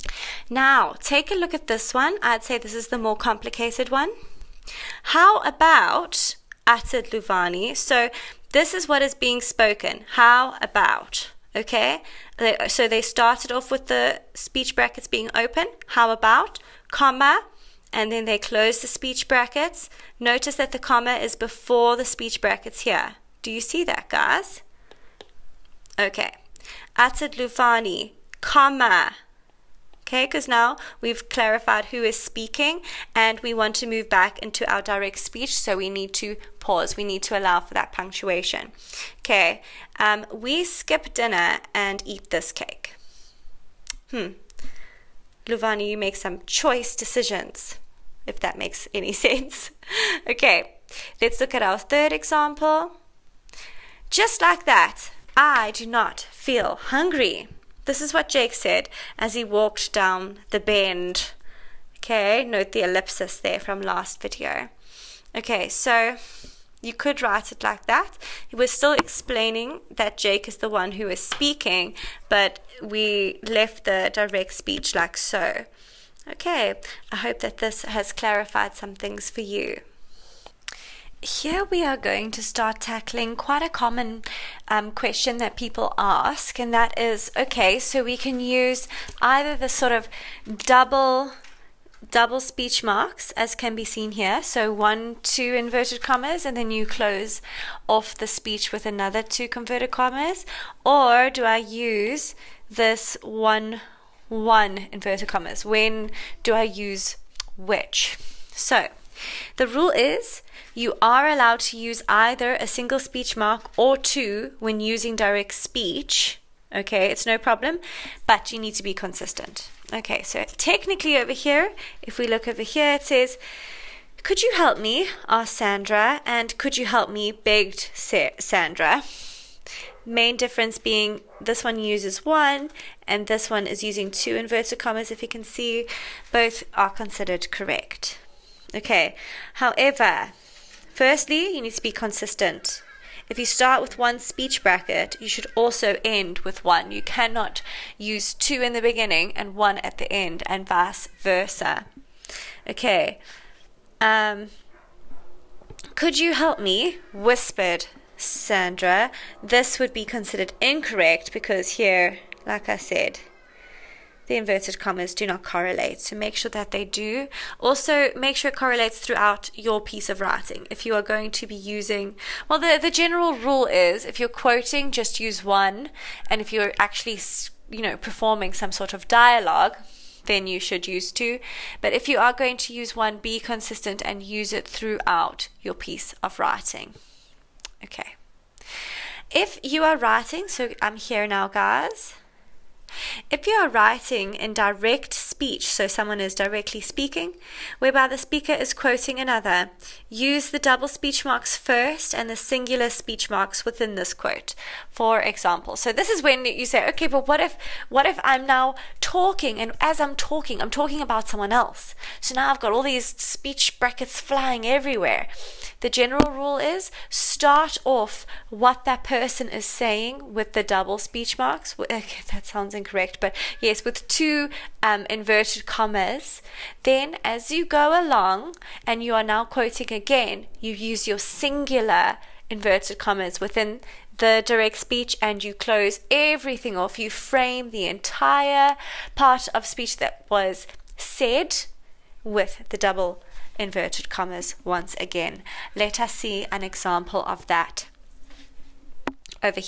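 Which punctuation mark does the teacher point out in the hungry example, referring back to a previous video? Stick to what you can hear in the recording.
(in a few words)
ellipsis.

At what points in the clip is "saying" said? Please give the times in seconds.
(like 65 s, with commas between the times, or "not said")
219 s.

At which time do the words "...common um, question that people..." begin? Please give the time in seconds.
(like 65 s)
83 s.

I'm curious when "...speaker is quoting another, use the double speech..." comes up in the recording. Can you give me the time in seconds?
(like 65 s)
198 s.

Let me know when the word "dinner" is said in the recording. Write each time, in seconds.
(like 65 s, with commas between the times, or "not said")
41 s.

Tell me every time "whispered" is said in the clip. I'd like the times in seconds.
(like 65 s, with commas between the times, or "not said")
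157 s.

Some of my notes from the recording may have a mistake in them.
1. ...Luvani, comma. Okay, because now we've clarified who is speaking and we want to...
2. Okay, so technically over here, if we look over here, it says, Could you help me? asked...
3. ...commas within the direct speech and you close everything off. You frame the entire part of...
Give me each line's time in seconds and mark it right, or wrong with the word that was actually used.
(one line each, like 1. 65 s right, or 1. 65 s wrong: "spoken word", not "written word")
1. 27 s right
2. 119 s right
3. 232 s right.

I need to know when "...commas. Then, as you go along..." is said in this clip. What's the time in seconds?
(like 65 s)
225 s.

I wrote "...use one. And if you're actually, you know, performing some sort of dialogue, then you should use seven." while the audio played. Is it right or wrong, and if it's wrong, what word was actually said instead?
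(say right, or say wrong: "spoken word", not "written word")
wrong: "two", not "seven".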